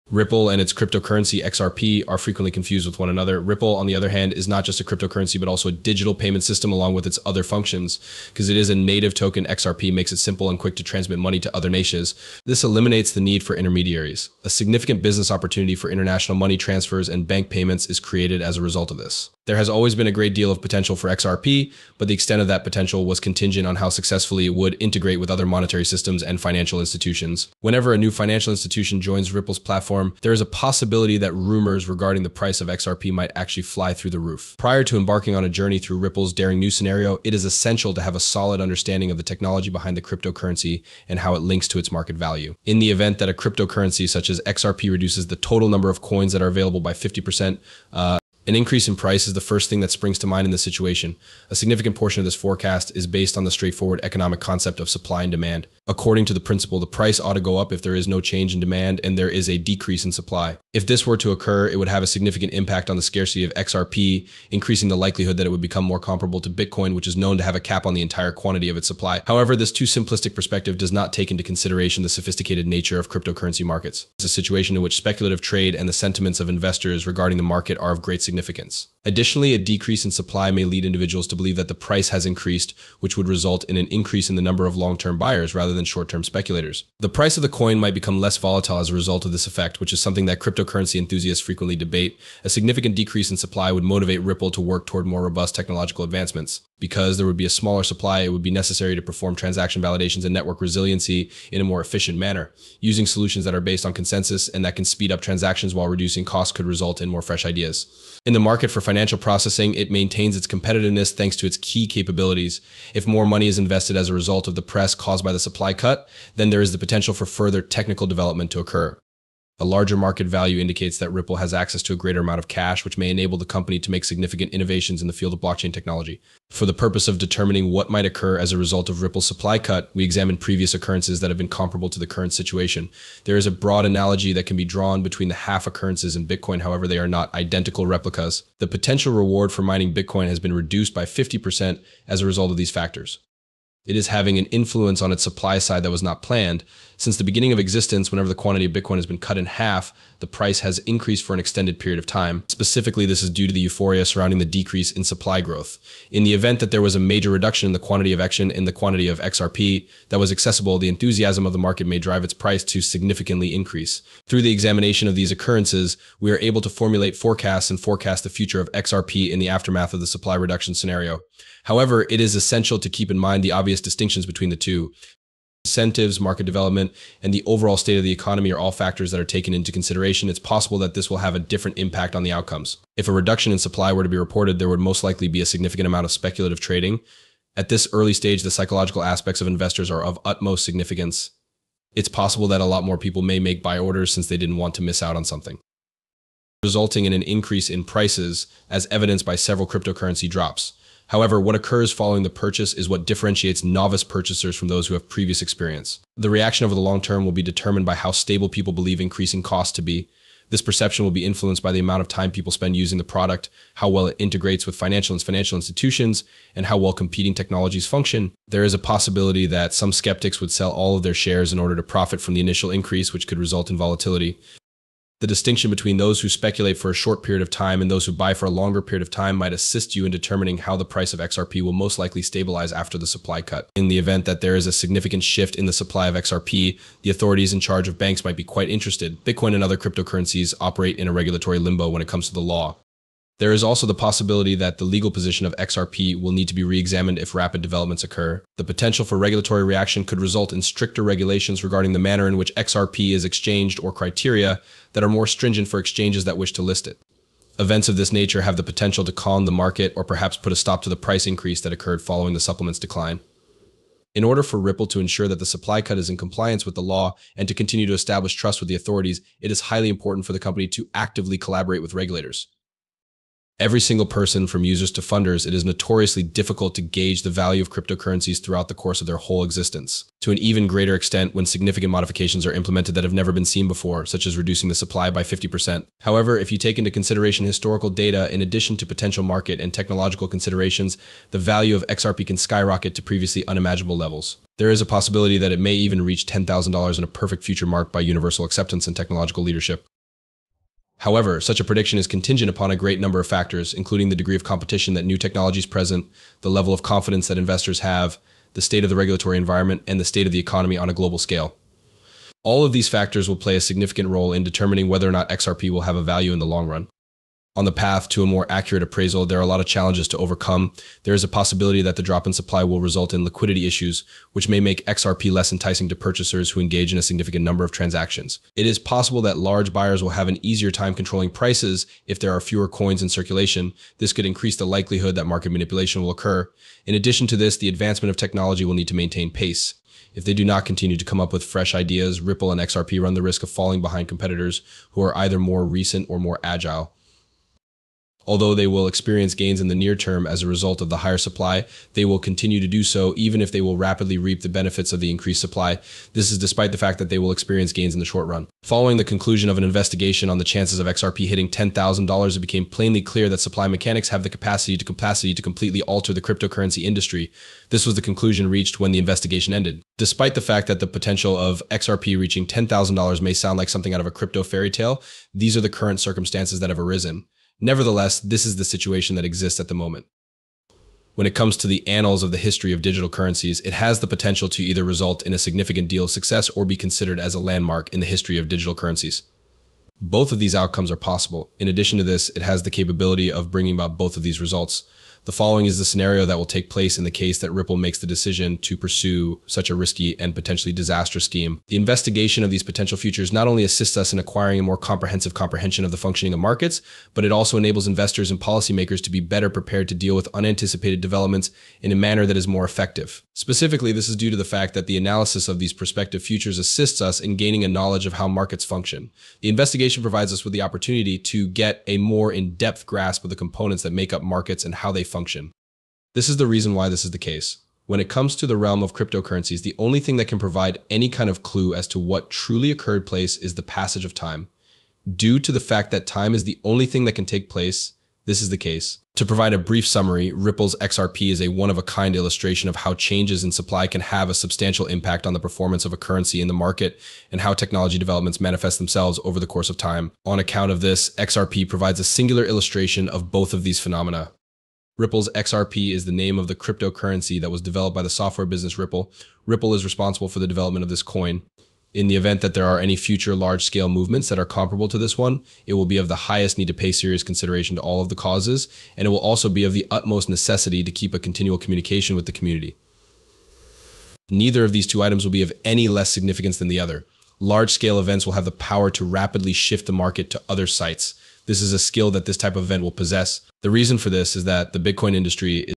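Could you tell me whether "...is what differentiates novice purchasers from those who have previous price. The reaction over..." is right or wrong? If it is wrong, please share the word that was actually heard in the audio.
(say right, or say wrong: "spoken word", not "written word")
wrong: "experience", not "price".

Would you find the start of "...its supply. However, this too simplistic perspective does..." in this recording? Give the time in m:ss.
1:08.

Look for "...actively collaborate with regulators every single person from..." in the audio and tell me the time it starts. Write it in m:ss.
4:30.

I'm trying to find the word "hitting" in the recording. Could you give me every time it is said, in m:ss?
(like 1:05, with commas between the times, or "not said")
6:01.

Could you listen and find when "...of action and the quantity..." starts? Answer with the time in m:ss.
2:38.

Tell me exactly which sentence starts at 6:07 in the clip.
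This was the conclusion reached when the investigation ended.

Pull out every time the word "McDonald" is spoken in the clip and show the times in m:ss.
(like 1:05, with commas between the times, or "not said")
not said.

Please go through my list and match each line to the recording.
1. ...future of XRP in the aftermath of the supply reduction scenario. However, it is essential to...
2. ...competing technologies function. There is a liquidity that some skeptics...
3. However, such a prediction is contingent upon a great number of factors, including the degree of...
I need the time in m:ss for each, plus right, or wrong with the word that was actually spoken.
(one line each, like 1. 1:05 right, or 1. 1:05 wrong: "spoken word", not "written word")
1. 2:48 right
2. 3:36 wrong: "possibility", not "liquidity"
3. 5:01 right.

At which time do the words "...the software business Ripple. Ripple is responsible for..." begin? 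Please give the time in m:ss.
7:38.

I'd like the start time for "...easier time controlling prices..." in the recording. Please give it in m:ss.
5:30.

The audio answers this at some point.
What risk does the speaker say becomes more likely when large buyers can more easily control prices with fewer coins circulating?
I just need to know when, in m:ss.
5:35.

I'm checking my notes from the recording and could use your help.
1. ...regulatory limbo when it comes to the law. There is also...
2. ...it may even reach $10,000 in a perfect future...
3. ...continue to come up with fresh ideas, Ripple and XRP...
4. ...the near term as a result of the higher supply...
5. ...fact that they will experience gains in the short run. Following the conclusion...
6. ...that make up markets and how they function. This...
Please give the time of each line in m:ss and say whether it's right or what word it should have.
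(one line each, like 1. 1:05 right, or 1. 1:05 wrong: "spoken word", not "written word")
1. 4:01 right
2. 4:55 right
3. 5:40 right
4. 5:49 right
5. 5:56 right
6. 7:03 right.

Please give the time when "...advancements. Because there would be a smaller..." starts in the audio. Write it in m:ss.
1:36.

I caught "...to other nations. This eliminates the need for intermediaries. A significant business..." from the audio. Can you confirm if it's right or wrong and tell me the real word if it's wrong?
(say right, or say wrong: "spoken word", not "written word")
right.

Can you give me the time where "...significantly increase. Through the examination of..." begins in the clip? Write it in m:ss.
2:42.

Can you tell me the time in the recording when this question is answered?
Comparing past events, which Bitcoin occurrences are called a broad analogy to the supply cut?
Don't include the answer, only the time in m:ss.
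2:15.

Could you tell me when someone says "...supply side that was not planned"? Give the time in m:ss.
2:25.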